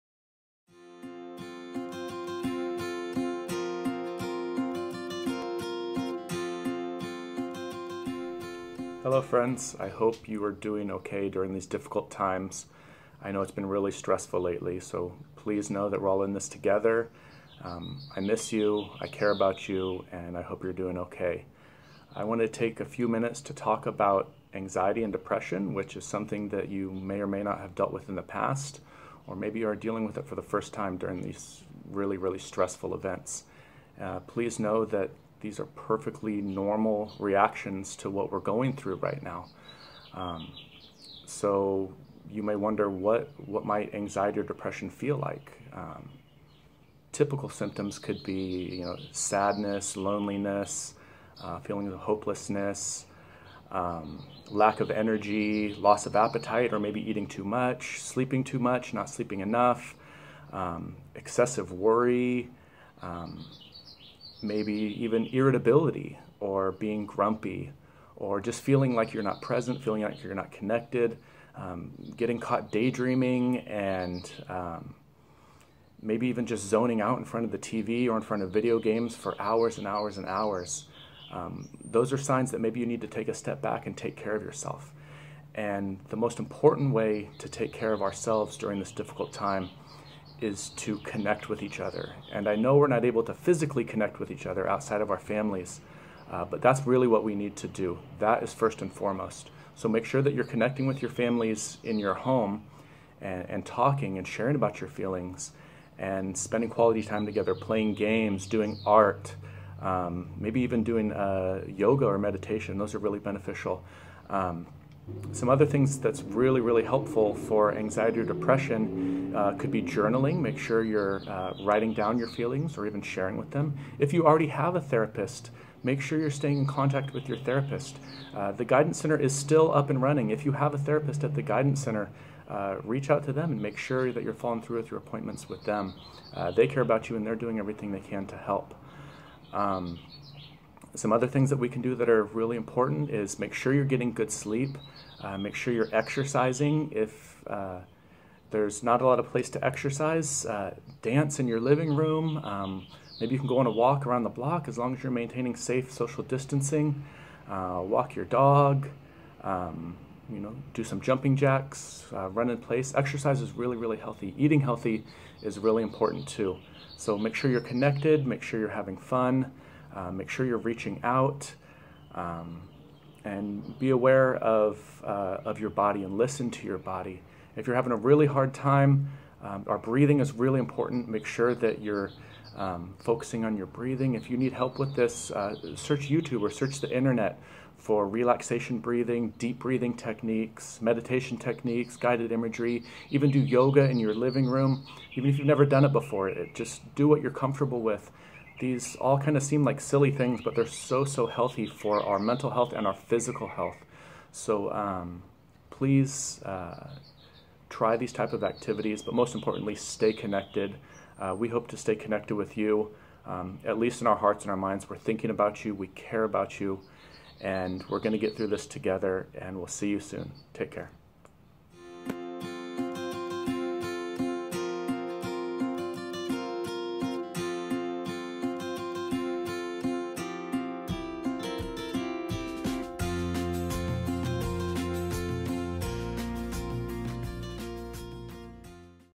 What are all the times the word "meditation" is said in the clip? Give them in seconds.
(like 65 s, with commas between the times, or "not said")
112 s, 190 s.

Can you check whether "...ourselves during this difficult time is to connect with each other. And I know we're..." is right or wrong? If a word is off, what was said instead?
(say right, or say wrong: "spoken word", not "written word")
right.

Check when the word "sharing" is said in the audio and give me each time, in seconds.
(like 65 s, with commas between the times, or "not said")
104 s, 123 s.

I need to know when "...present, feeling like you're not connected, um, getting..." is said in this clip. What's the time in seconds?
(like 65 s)
69 s.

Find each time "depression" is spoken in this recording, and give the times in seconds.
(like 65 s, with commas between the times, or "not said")
25 s, 44 s, 118 s.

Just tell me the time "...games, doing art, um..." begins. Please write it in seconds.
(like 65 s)
107 s.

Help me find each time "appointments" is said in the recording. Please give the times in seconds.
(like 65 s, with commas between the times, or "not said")
134 s.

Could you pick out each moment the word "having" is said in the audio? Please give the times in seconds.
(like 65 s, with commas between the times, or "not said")
168 s, 177 s.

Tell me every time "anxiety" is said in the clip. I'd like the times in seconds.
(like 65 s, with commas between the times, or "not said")
24 s, 43 s, 117 s.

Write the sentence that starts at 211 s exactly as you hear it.
Uh, we hope to stay connected with you, um, at least in our hearts and our minds.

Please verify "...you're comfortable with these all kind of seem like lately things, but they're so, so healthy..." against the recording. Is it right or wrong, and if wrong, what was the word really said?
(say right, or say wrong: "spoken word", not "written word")
wrong: "silly", not "lately".